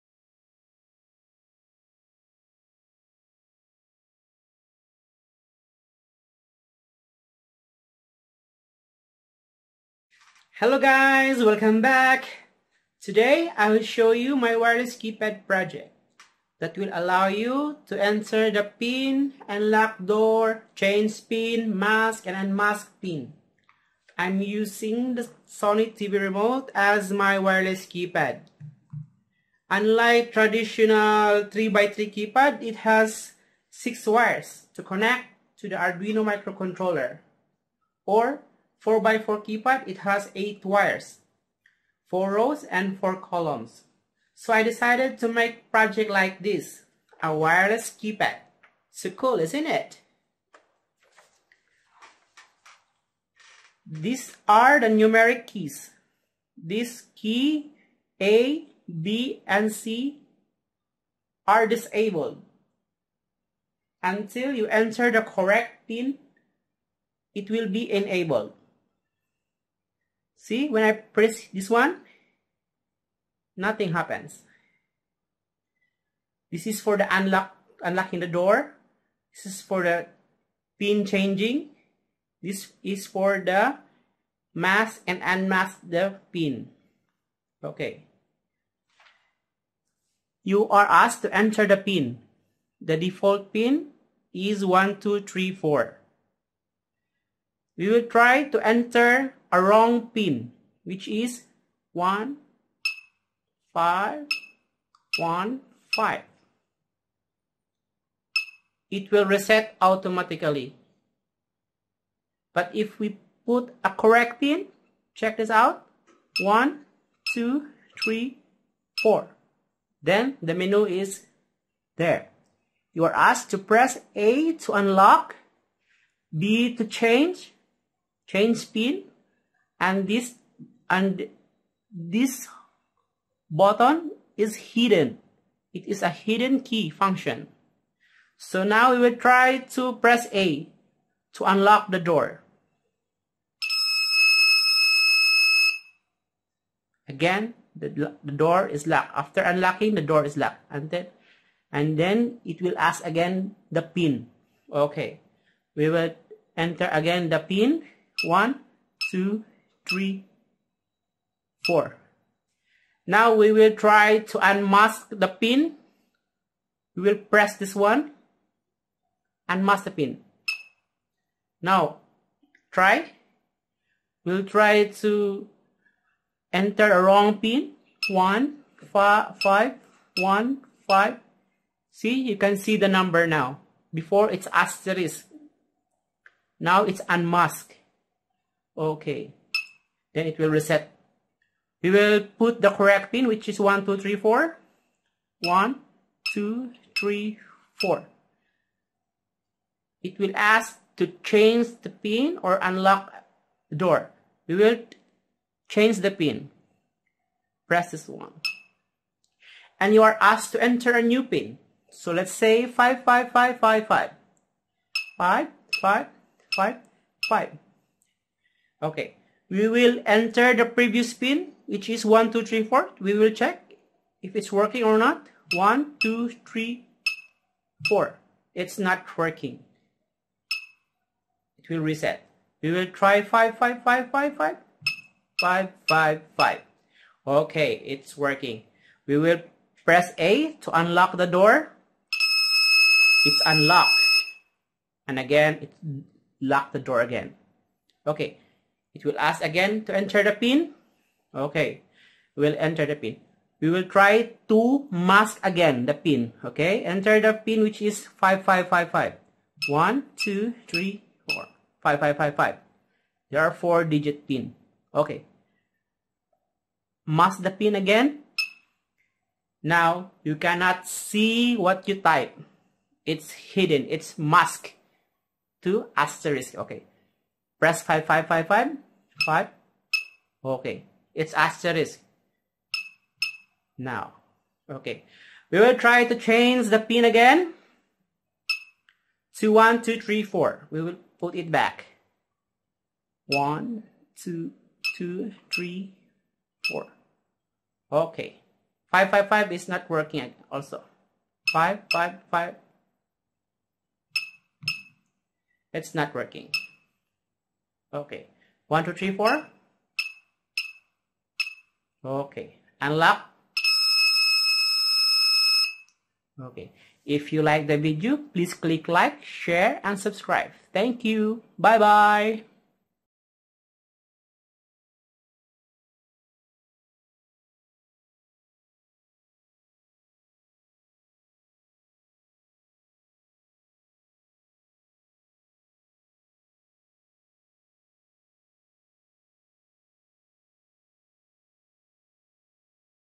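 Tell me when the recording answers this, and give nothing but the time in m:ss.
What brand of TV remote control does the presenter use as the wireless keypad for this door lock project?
0:25.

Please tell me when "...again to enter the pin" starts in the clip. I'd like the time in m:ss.
4:09.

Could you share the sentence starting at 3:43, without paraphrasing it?
We will check if it's working or not.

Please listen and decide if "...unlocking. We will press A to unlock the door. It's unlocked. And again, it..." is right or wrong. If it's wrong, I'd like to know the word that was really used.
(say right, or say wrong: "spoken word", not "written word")
wrong: "working", not "unlocking".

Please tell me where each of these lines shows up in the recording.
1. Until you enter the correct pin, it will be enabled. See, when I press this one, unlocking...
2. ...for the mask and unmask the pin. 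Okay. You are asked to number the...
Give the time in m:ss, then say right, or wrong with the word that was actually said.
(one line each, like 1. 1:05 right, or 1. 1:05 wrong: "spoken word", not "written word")
1. 1:04 wrong: "nothing", not "unlocking"
2. 1:23 wrong: "enter", not "number".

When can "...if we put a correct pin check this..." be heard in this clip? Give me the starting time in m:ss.
1:52.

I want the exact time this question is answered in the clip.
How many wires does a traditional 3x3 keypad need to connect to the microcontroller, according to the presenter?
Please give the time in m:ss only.
0:33.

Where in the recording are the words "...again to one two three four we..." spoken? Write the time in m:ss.
4:47.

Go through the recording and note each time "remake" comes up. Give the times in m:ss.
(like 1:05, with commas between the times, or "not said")
not said.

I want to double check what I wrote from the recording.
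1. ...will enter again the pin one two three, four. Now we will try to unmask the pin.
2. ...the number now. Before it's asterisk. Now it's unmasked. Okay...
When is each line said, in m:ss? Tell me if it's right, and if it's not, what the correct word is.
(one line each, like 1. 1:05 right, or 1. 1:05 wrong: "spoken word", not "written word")
1. 2:35 right
2. 3:02 right.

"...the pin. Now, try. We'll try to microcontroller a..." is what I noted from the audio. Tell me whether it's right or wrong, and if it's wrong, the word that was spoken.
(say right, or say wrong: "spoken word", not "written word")
wrong: "enter", not "microcontroller".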